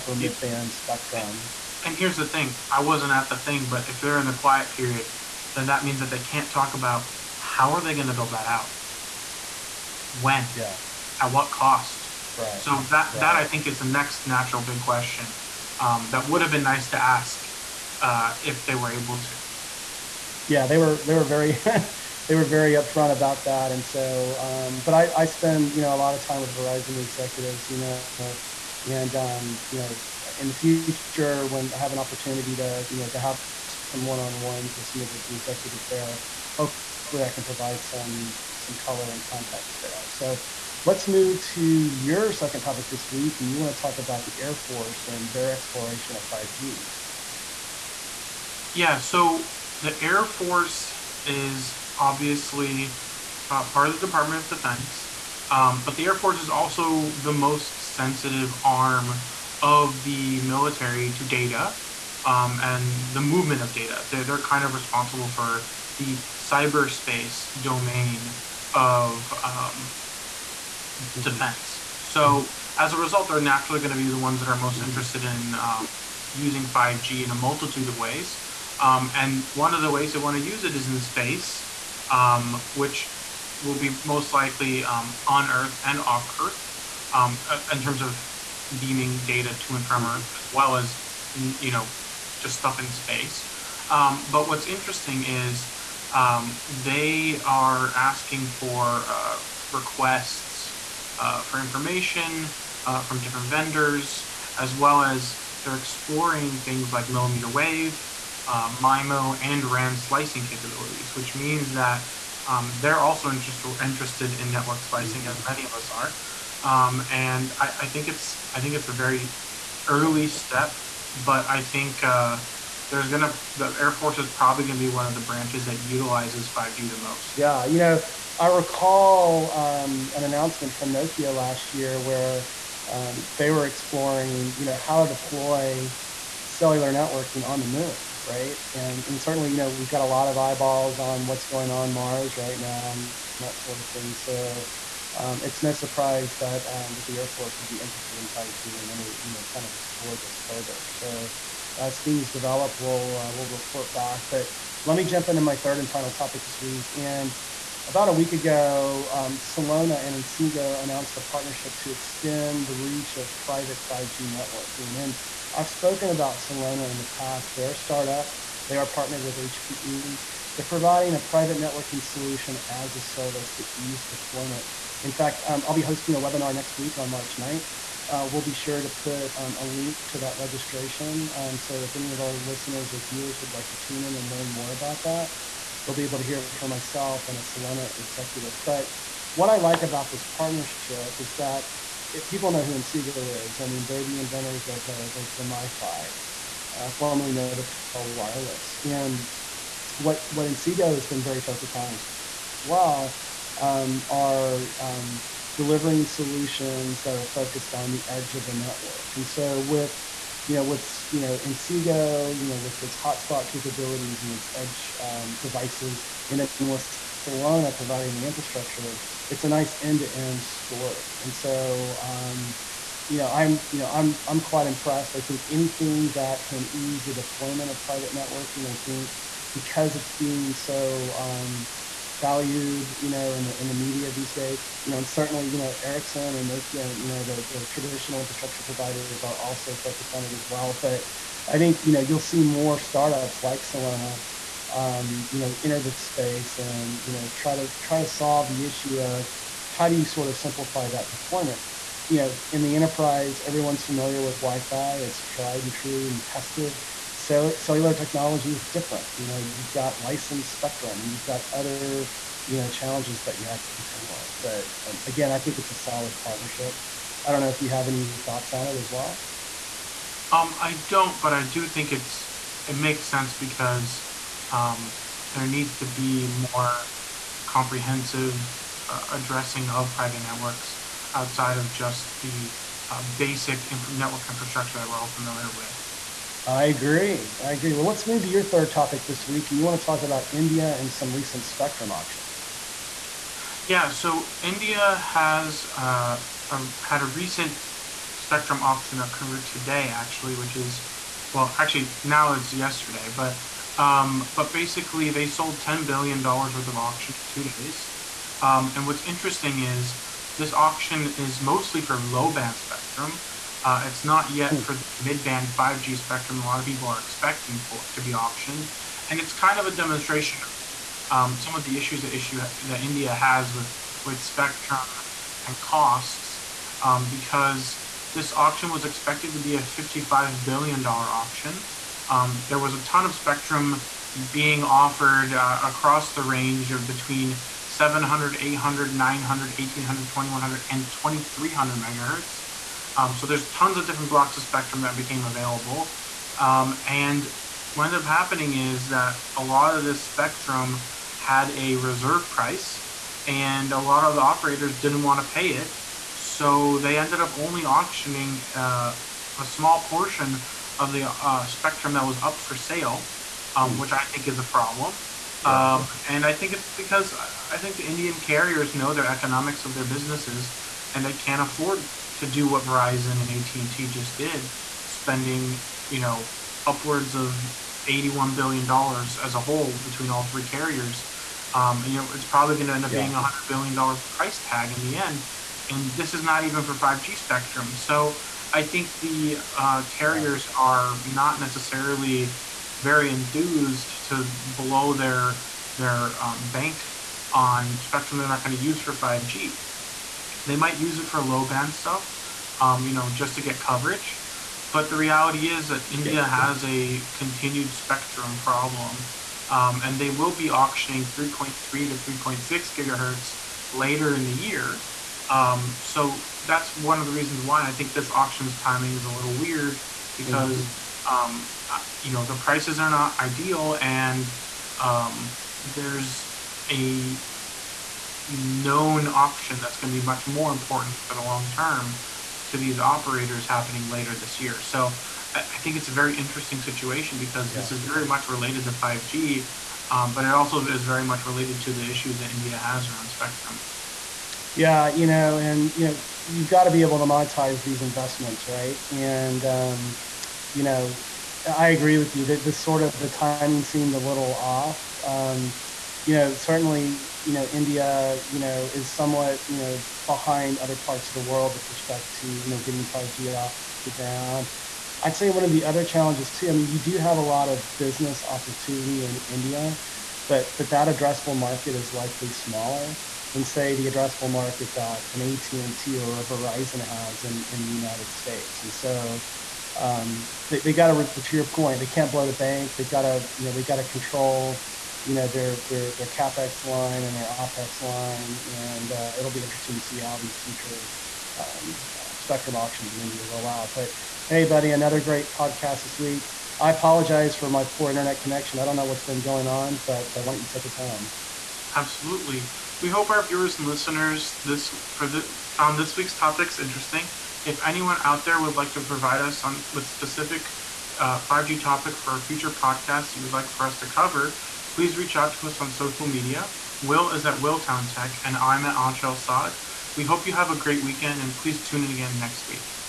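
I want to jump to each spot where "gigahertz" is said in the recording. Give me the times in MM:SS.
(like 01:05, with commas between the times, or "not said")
06:52.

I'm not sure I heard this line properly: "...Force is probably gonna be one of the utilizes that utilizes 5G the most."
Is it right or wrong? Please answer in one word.
wrong.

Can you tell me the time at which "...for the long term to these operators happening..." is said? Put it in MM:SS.
07:11.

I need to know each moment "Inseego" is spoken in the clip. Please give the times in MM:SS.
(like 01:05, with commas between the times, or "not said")
02:40, 03:12, 03:20, 03:31.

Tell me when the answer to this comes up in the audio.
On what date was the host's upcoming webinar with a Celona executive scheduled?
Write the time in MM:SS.
02:57.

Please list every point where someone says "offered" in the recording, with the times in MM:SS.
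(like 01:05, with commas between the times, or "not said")
05:34.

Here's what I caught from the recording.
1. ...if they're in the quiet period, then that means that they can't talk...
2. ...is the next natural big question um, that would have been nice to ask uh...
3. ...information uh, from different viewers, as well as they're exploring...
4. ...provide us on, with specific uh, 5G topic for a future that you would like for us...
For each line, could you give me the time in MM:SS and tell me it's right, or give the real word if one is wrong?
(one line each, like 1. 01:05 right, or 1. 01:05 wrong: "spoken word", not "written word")
1. 00:03 right
2. 00:13 right
3. 01:41 wrong: "vendors", not "viewers"
4. 08:28 right.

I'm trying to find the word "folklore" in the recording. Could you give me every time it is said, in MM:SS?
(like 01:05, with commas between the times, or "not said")
not said.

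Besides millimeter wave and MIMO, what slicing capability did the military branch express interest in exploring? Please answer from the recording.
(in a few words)
RAN slicing.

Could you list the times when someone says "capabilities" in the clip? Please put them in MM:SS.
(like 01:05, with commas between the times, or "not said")
01:50, 03:33.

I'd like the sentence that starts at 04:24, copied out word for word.
But um, again, I think it's a solid partnership.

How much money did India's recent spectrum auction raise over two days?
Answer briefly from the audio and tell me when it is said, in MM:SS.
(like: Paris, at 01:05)
$10 billion, at 05:05.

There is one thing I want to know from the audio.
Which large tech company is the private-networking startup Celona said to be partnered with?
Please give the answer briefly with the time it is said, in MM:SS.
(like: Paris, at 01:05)
HPE, at 02:49.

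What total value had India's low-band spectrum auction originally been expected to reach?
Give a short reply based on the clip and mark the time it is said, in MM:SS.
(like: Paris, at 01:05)
$55 billion, at 05:29.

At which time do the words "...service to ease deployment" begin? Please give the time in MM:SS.
02:53.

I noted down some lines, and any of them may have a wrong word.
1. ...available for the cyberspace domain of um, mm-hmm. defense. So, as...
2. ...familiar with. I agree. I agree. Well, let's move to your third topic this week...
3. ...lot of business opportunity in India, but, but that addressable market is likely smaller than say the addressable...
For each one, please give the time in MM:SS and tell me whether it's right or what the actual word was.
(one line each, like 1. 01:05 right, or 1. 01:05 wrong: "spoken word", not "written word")
1. 01:04 wrong: "responsible", not "available"
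2. 04:45 right
3. 07:47 right.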